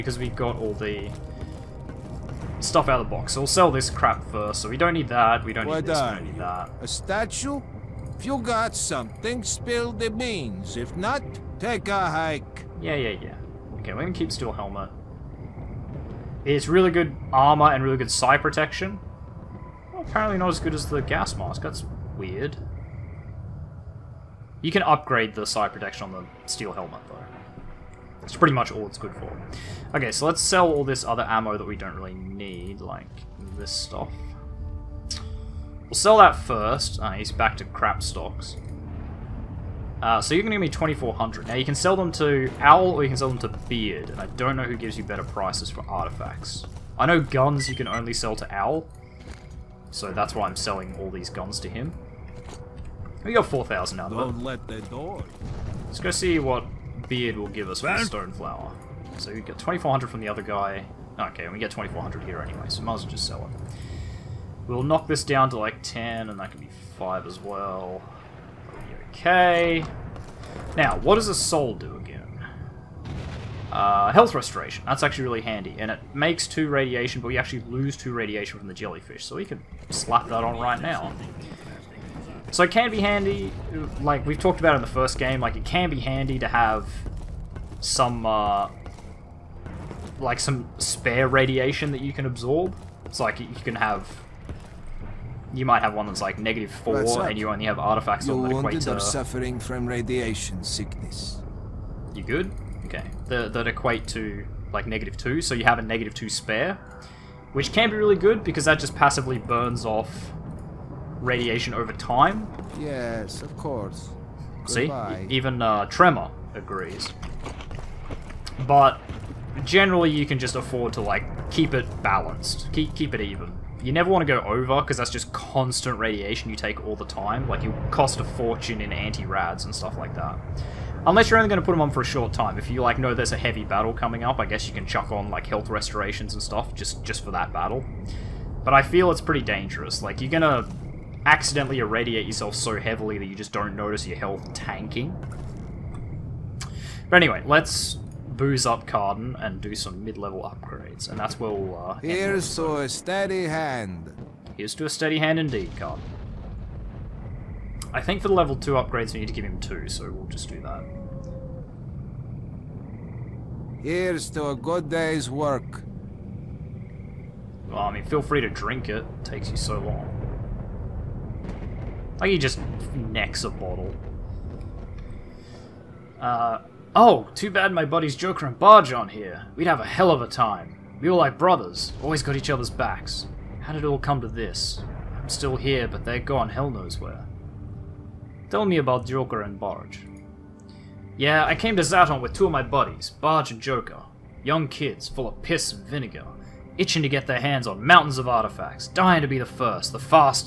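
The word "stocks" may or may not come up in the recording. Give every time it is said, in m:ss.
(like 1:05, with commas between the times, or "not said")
0:38.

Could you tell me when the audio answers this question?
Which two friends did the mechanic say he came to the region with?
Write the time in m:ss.
3:13.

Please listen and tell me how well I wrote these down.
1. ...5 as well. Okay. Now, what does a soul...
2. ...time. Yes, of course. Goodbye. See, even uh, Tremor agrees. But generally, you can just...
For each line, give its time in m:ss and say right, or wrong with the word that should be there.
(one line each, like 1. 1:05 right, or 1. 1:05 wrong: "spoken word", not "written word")
1. 1:06 right
2. 1:51 right.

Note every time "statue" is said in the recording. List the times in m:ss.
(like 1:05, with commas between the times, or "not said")
0:06.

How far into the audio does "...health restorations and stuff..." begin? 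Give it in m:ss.
2:15.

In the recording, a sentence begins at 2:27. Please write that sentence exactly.
But anyway, let's booze up Cardan and do some mid-level upgrades, and that's where we'll...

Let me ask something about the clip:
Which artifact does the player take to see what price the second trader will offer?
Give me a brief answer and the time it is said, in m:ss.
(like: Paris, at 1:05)
Stone flower, at 0:58.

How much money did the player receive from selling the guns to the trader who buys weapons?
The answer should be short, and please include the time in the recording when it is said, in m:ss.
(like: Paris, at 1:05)
4,000, at 0:53.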